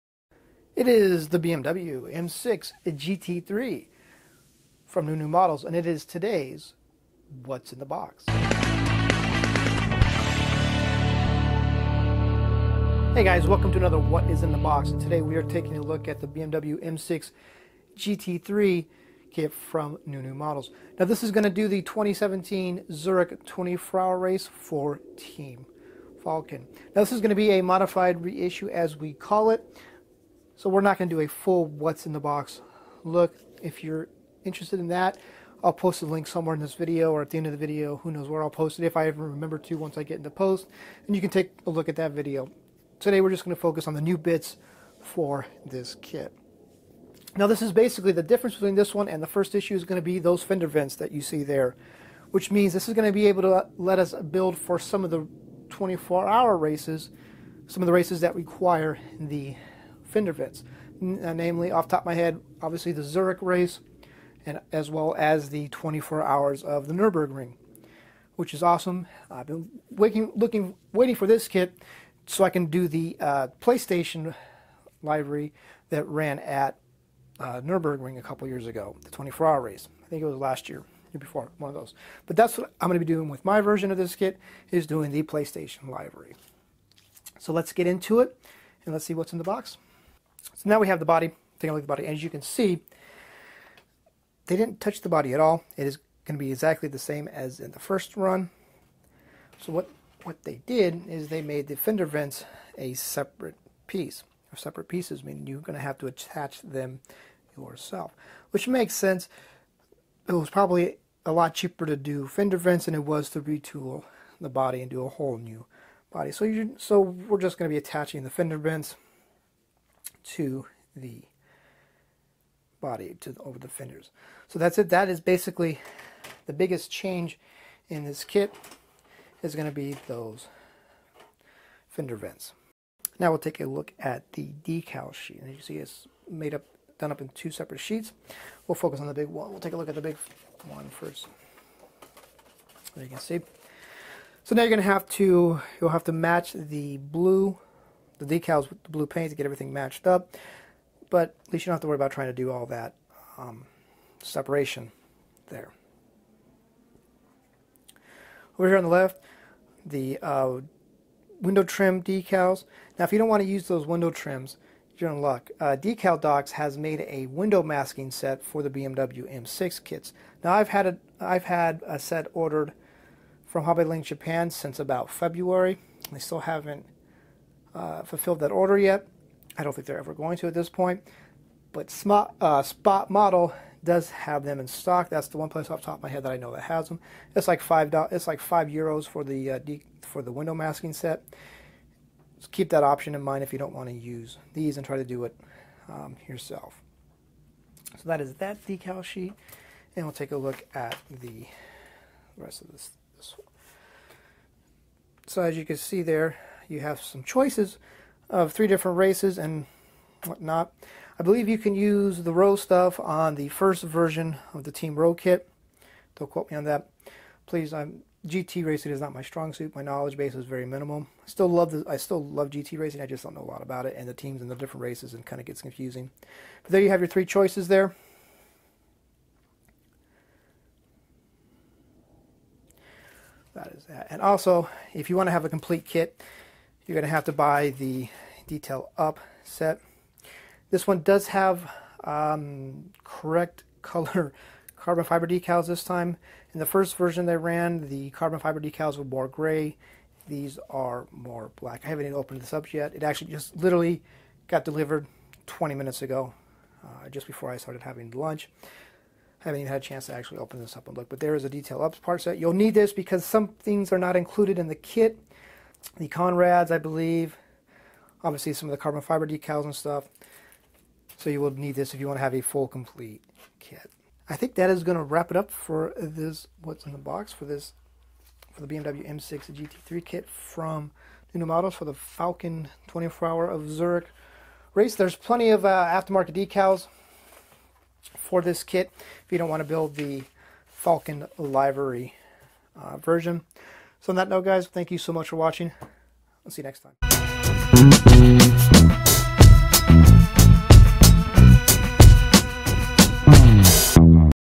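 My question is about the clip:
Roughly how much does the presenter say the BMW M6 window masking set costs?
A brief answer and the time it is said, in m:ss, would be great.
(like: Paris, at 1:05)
5 euros, at 3:08.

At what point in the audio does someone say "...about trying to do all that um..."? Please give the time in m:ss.
2:31.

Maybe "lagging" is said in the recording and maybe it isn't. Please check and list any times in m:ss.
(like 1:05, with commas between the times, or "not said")
not said.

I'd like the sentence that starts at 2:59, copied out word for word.
I don't think they're ever going to at this point.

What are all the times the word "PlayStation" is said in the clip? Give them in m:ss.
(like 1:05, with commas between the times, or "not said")
1:13, 1:25.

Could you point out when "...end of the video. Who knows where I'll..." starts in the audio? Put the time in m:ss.
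0:37.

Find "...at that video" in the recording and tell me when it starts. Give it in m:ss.
0:41.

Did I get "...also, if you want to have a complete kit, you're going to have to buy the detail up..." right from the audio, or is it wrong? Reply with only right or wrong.
right.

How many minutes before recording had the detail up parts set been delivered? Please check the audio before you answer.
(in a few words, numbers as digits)
20.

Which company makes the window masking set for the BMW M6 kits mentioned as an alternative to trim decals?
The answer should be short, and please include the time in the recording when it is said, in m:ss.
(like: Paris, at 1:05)
Decal Docs, at 2:45.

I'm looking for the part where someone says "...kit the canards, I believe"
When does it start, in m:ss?
4:24.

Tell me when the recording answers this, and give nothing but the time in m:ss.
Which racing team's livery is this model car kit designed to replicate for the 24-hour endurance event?
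0:25.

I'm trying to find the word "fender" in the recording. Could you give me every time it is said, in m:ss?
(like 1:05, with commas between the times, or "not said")
0:50, 1:00, 1:41, 1:52, 1:58, 2:03, 2:11.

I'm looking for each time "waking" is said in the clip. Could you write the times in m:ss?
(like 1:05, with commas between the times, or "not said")
1:09.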